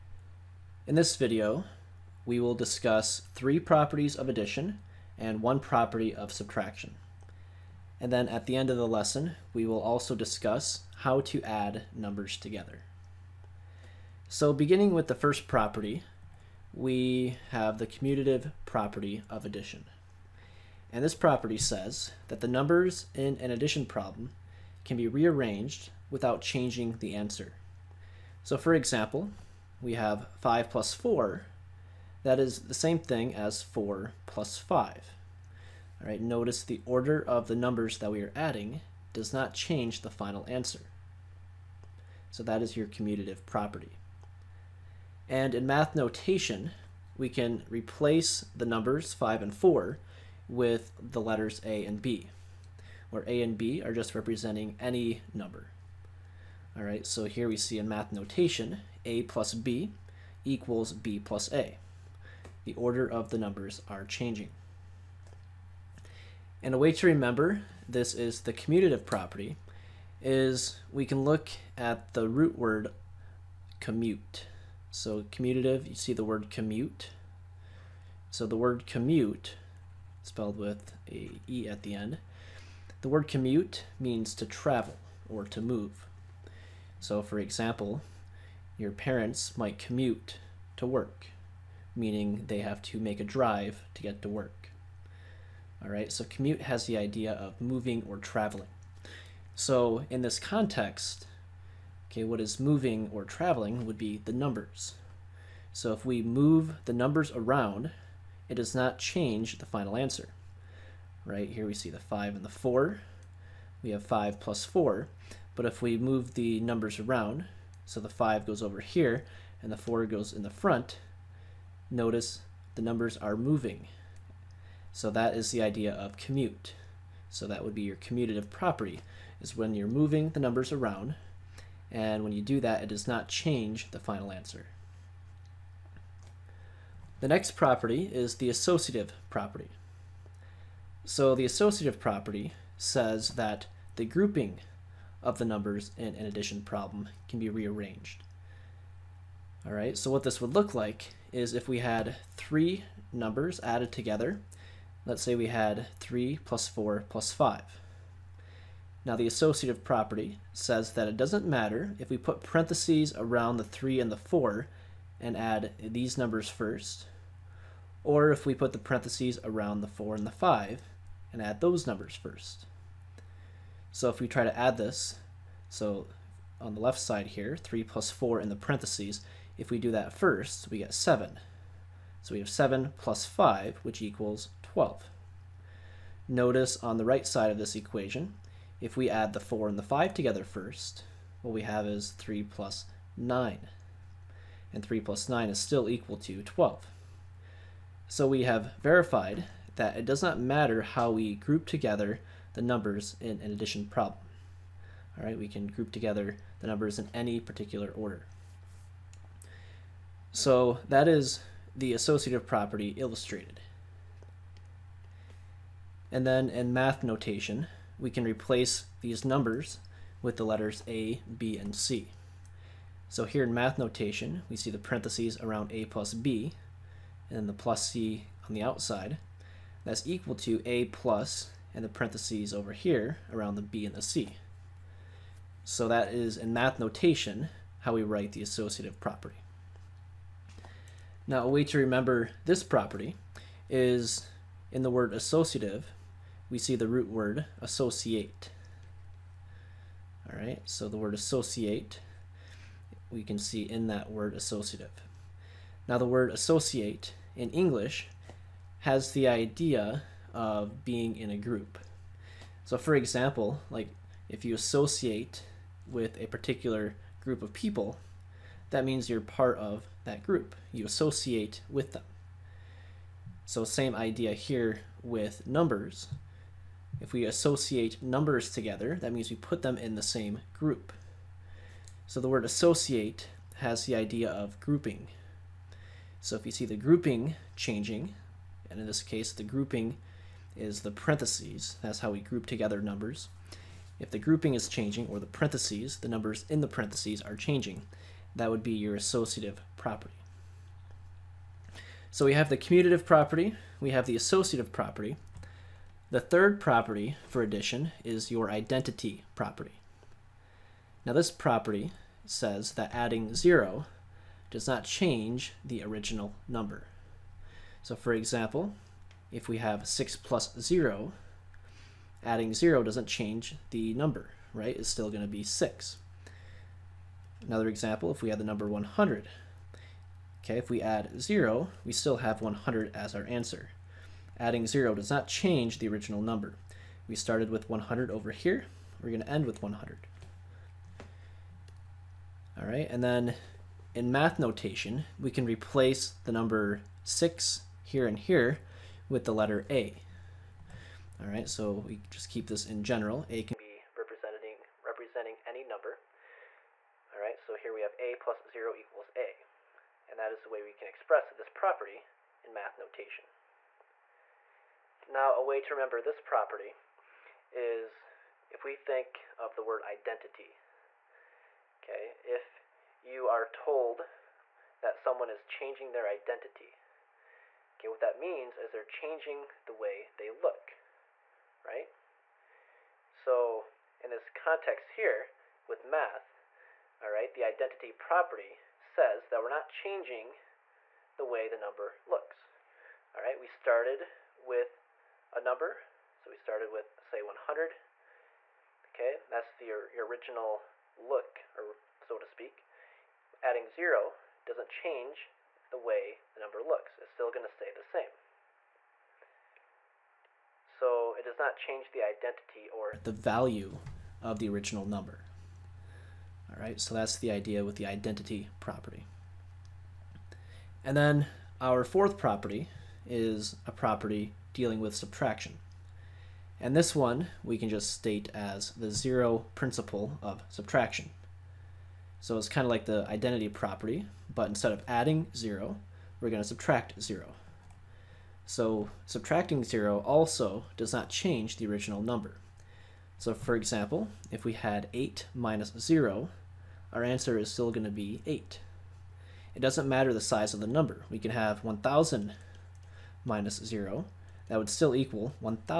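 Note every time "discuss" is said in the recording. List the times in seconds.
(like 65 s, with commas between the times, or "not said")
2 s, 10 s.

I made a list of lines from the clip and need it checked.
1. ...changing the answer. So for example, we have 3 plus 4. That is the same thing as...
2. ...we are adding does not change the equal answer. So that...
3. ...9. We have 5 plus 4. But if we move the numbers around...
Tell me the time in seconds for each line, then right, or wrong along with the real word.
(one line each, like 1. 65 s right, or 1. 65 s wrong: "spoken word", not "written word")
1. 26 s wrong: "5", not "3"
2. 38 s wrong: "final", not "equal"
3. 112 s wrong: "4", not "9".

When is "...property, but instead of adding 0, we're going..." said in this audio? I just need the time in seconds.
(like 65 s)
433 s.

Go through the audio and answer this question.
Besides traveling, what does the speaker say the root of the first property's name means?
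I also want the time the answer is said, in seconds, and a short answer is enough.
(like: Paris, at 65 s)
to move, at 85 s.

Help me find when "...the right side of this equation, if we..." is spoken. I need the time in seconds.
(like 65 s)
186 s.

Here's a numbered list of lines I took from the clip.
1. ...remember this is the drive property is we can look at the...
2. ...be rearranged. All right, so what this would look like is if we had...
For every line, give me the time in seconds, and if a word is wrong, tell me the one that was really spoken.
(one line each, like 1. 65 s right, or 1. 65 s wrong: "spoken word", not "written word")
1. 67 s wrong: "commutative", not "drive"
2. 147 s right.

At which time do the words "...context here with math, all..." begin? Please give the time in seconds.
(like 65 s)
384 s.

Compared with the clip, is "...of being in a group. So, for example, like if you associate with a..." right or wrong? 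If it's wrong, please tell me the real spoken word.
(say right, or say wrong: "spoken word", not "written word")
right.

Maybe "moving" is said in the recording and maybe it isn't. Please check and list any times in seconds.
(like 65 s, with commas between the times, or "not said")
97 s, 102 s, 123 s, 129 s.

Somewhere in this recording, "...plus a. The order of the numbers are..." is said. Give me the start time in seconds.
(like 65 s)
61 s.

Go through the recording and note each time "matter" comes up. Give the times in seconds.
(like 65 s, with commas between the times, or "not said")
161 s, 200 s, 449 s.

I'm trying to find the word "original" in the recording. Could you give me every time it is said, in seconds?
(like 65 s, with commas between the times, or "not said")
315 s, 335 s, 400 s, 414 s, 441 s.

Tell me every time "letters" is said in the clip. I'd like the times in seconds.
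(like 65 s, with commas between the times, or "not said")
51 s, 220 s, 349 s.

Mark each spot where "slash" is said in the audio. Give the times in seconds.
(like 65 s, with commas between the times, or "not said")
not said.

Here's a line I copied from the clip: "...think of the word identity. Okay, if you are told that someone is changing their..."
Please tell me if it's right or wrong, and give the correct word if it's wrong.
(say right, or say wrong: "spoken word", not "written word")
right.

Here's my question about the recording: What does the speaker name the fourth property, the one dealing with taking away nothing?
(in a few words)
zero principle of subtraction.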